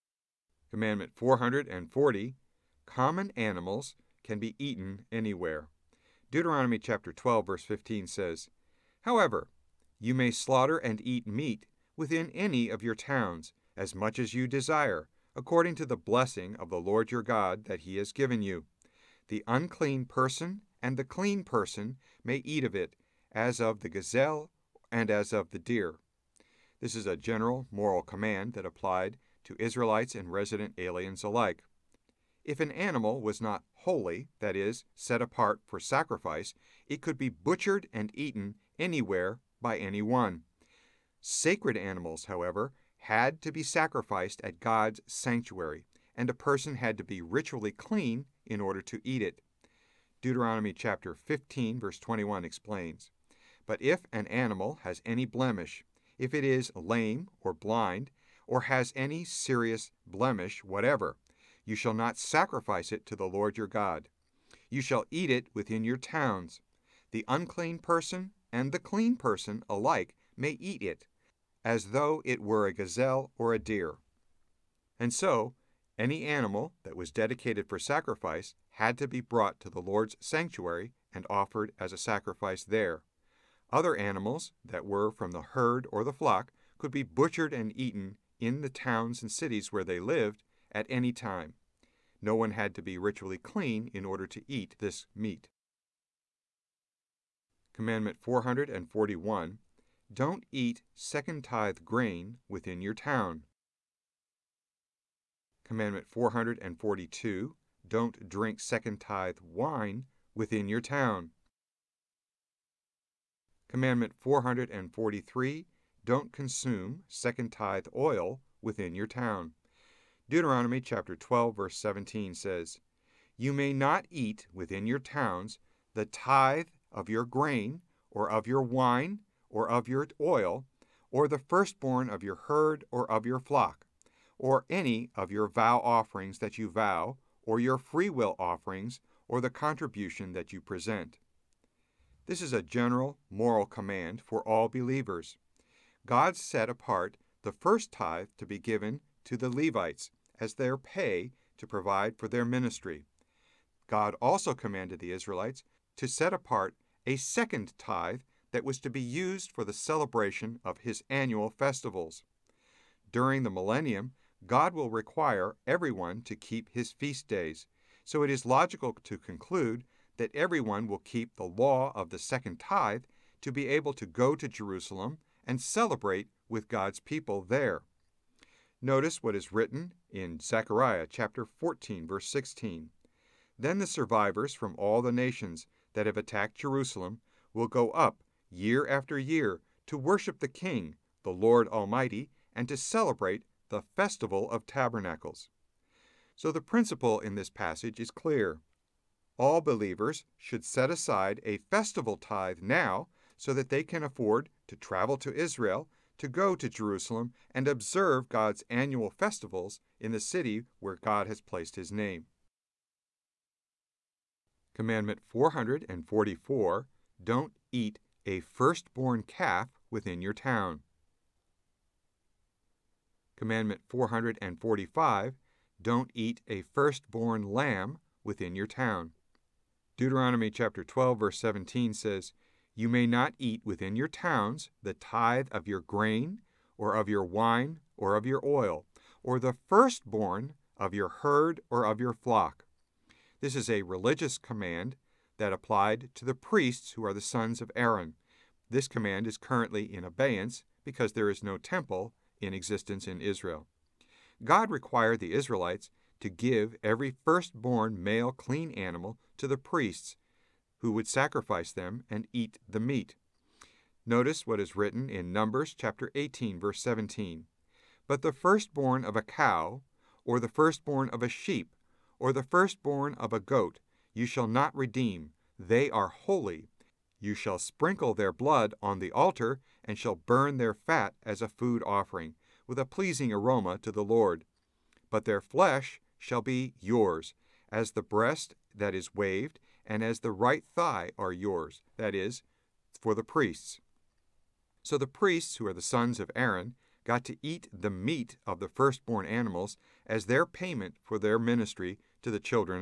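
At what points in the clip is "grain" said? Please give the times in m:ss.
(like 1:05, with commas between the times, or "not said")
1:41, 2:07, 3:55.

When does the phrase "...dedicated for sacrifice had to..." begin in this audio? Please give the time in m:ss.
1:17.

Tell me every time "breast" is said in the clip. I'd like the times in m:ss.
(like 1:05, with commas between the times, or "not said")
4:48.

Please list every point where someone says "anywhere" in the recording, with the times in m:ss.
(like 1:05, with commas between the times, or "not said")
0:05, 0:38.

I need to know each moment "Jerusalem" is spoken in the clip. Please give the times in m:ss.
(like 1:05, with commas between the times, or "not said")
2:54, 3:06, 3:26.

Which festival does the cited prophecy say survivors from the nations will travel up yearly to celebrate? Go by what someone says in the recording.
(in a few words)
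festival of tabernacles.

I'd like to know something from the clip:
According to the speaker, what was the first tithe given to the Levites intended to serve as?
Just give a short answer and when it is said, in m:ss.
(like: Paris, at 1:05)
their pay, at 2:30.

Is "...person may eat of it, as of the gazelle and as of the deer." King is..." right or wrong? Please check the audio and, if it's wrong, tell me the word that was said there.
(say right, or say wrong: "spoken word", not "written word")
wrong: "This", not "King".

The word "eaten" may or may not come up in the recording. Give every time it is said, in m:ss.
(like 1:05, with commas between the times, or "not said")
0:04, 0:38, 1:27.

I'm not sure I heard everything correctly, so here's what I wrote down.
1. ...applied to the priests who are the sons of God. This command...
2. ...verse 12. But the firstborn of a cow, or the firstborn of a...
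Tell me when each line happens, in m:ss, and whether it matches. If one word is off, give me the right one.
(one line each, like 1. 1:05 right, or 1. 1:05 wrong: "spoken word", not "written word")
1. 4:05 wrong: "Aaron", not "God"
2. 4:26 wrong: "17", not "12".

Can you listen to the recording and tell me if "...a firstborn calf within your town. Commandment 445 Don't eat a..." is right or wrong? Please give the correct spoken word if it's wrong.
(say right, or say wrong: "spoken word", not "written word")
right.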